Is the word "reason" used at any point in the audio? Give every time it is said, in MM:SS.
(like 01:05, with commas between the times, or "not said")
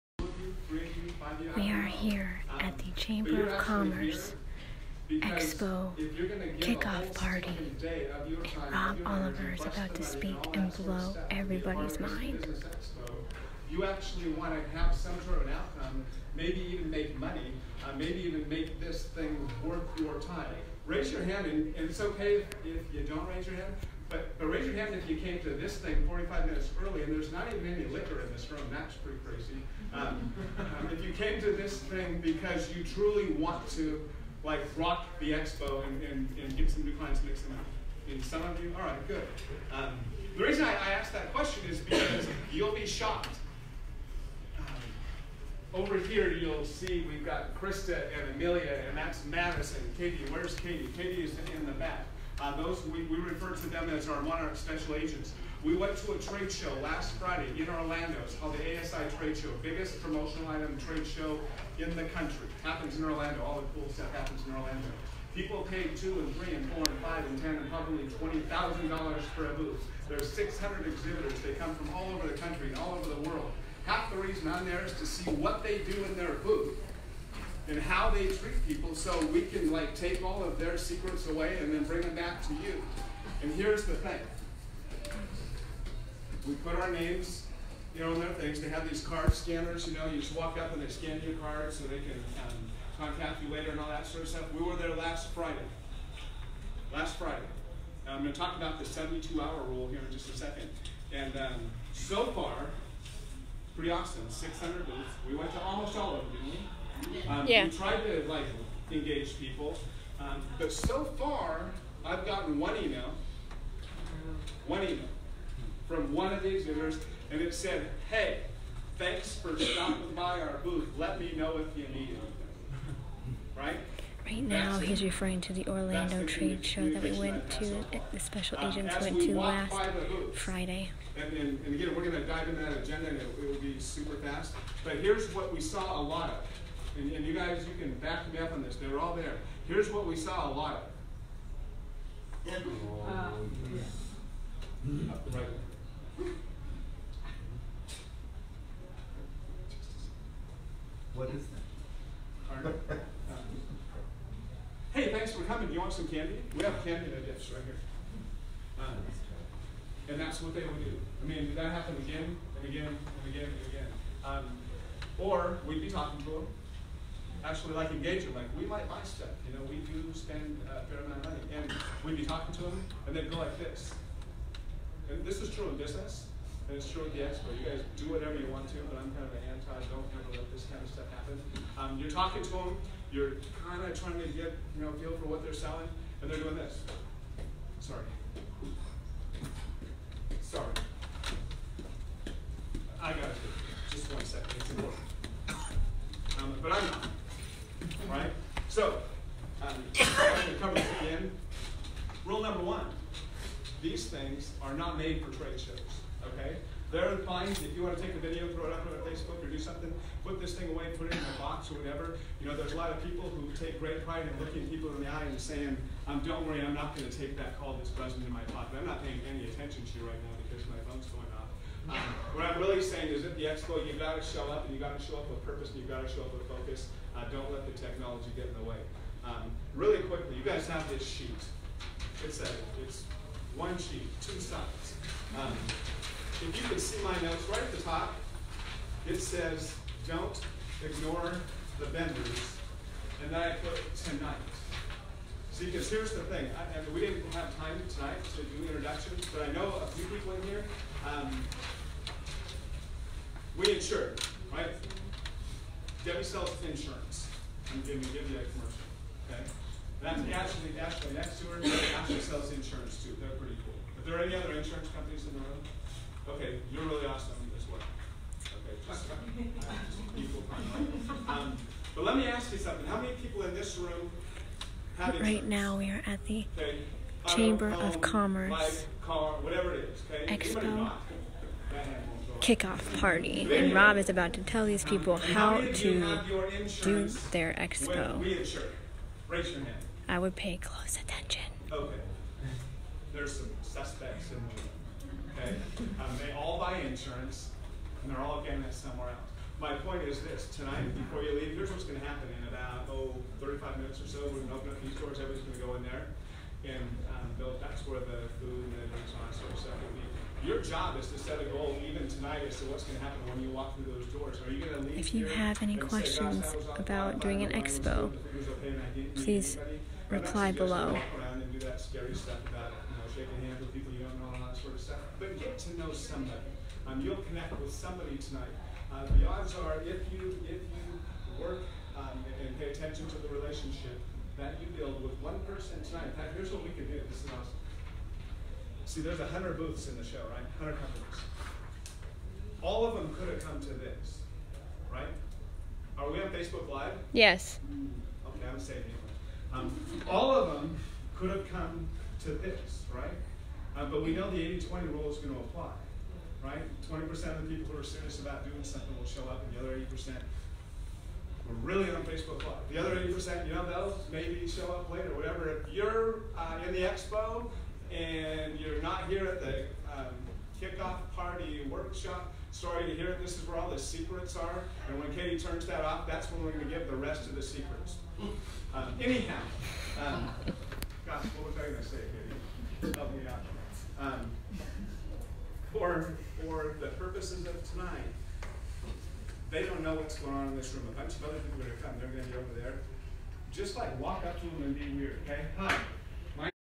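00:40, 01:14.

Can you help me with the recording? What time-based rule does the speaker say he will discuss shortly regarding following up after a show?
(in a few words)
72-hour rule.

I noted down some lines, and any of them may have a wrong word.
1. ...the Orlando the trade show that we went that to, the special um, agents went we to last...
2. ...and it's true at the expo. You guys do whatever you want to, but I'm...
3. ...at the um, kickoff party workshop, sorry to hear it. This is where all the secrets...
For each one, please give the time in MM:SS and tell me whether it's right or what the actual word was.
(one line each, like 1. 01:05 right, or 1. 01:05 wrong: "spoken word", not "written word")
1. 02:05 right
2. 02:56 right
3. 06:09 right.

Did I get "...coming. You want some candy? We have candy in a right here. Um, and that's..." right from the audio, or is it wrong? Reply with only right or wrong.
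right.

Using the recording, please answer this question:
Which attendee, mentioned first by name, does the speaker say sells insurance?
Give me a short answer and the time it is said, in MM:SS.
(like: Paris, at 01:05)
Debbie, at 04:16.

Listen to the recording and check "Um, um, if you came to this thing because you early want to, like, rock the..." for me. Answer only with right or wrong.
wrong.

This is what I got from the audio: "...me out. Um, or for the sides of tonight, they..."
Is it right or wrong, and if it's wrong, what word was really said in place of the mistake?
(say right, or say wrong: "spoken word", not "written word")
wrong: "purposes", not "sides".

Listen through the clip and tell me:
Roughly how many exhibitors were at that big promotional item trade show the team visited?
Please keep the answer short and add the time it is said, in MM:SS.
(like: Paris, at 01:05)
600, at 01:10.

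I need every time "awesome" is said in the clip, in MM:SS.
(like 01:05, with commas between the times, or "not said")
01:43, 04:27, 05:37.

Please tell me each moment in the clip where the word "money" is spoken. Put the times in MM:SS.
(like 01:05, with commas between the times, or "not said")
00:17, 02:51.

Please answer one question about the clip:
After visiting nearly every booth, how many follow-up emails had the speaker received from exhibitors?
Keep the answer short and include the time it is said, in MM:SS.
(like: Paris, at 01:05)
1, at 01:52.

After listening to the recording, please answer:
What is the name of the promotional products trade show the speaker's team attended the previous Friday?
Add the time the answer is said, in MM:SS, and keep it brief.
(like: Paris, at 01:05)
ASI Trade Show, at 00:58.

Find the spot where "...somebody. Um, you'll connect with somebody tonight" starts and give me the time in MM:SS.
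05:25.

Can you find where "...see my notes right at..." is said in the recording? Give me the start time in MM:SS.
03:56.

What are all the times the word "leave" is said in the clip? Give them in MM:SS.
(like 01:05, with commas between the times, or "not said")
05:01, 05:14.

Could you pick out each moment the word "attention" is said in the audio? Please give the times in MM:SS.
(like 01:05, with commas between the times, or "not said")
03:39, 04:50, 05:32.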